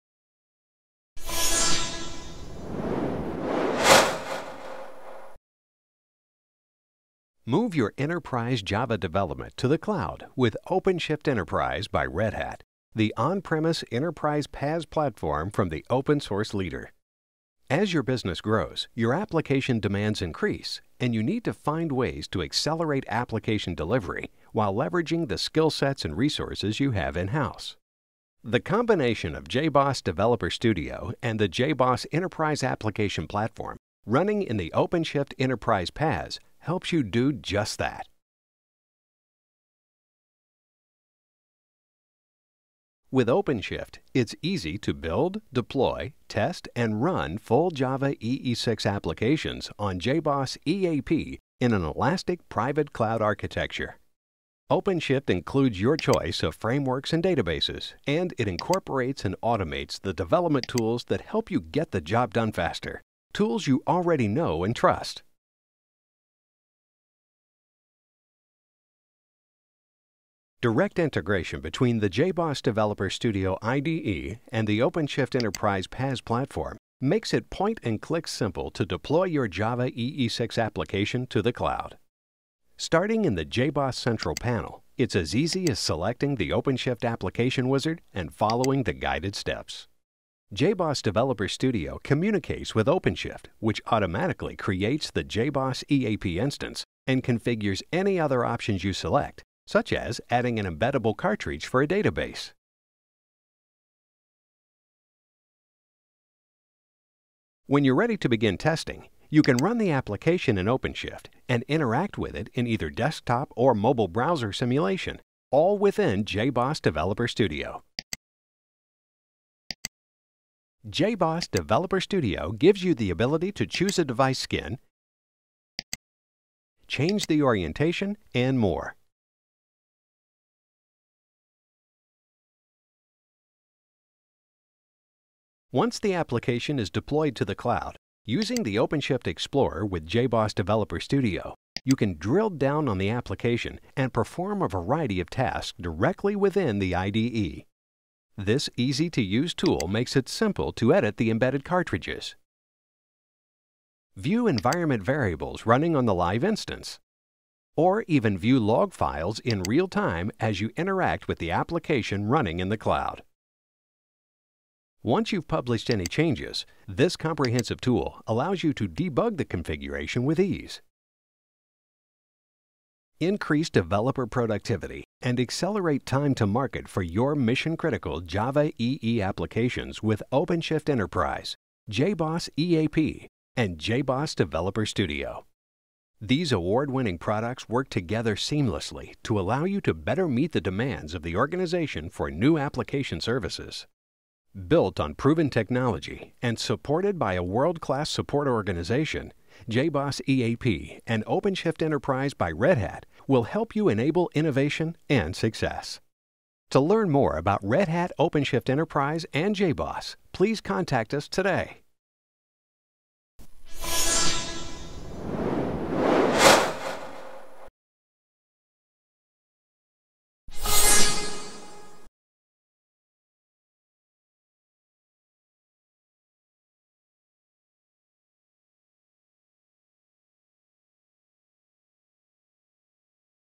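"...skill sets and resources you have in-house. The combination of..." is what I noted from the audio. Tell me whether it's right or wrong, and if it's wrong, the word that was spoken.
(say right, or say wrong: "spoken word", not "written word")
right.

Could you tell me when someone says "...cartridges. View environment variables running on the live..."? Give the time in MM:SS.
02:31.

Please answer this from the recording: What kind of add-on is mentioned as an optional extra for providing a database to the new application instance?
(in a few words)
embeddable cartridge.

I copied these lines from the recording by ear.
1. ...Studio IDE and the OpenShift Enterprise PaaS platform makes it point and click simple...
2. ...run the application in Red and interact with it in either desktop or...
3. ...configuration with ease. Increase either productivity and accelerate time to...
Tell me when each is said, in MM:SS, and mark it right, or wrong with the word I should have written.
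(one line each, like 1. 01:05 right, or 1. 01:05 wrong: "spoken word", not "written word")
1. 01:13 right
2. 01:49 wrong: "OpenShift", not "Red"
3. 02:49 wrong: "developer", not "either".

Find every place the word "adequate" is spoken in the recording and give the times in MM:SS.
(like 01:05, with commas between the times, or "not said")
not said.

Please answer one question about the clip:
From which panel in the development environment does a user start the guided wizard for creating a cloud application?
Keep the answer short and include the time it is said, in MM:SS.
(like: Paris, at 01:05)
JBoss Central, at 01:23.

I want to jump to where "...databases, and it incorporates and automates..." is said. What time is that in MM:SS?
00:57.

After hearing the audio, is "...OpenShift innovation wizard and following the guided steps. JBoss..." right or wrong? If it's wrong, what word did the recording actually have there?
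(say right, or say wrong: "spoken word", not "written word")
wrong: "application", not "innovation".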